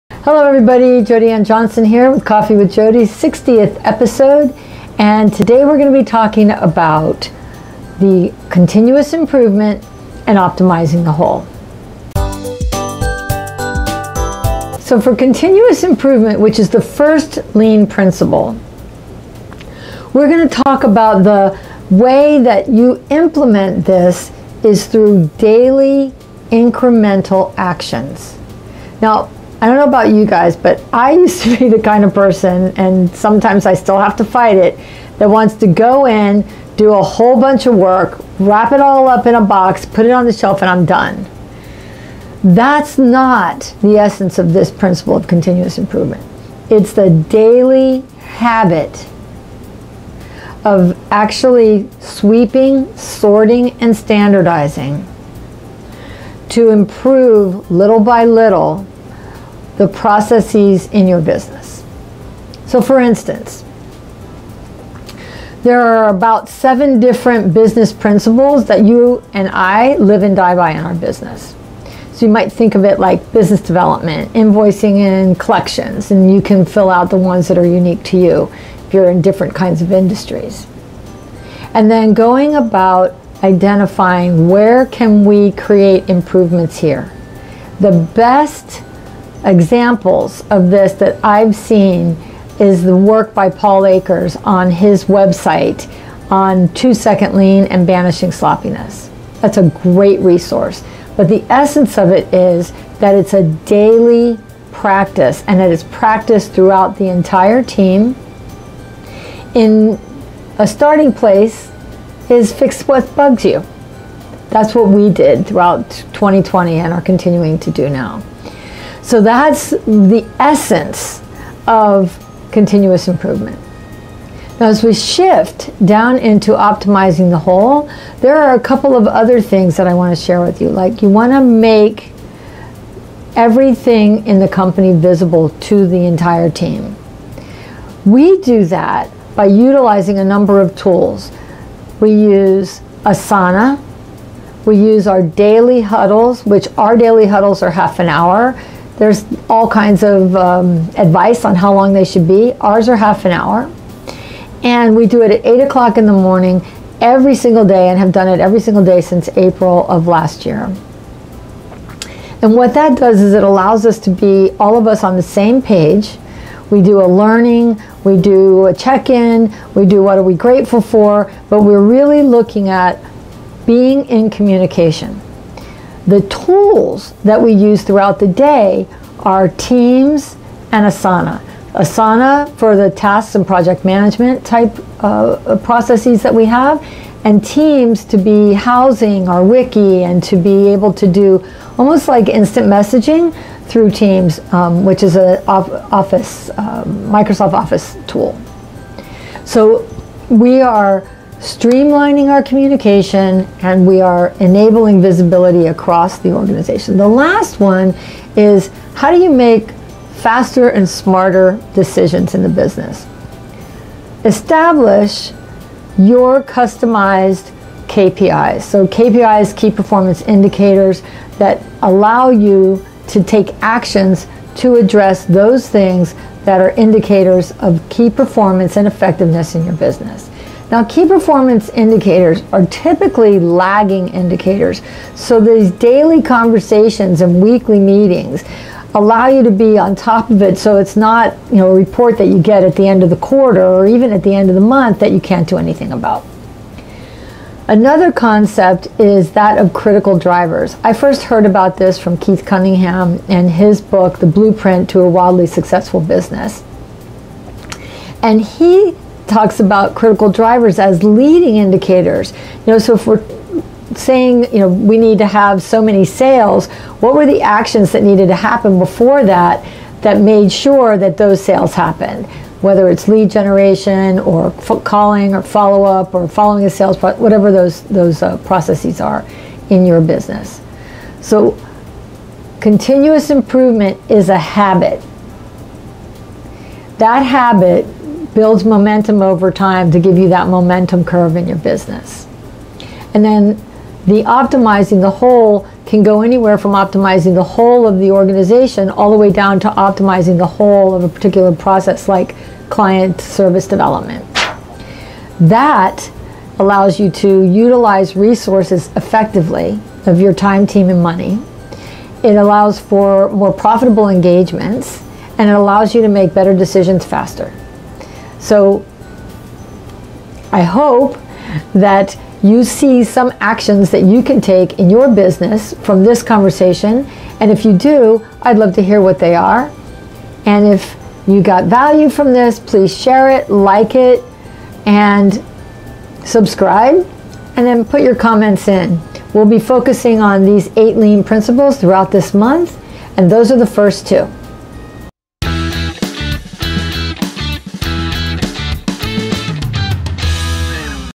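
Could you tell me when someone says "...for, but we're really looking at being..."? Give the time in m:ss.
2:50.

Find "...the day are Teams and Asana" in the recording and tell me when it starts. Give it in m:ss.
2:58.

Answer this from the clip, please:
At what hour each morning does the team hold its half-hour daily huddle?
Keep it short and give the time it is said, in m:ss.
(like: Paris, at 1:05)
8 o'clock, at 2:35.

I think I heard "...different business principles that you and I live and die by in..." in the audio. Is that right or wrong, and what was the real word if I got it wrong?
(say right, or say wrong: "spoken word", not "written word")
right.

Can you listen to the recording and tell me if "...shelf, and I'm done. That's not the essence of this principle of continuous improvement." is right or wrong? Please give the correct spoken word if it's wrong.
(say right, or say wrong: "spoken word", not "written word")
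right.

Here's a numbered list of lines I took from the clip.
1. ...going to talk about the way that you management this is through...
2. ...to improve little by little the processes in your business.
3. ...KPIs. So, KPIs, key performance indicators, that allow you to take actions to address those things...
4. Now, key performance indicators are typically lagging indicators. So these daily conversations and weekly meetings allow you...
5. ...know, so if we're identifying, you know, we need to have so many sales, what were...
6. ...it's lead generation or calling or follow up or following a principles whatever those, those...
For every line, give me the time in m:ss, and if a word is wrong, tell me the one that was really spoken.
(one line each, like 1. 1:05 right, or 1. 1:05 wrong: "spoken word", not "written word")
1. 0:20 wrong: "implement", not "management"
2. 0:56 right
3. 3:37 right
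4. 3:50 right
5. 4:22 wrong: "saying", not "identifying"
6. 4:32 wrong: "sales", not "principles".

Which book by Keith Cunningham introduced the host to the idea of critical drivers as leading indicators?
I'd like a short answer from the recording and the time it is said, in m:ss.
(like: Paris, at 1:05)
The Blueprint to a Wildly Successful Business, at 4:14.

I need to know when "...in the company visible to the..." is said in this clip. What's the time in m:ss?
2:14.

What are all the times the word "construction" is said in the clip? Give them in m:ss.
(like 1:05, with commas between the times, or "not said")
not said.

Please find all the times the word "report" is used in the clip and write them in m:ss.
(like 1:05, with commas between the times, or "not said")
4:01.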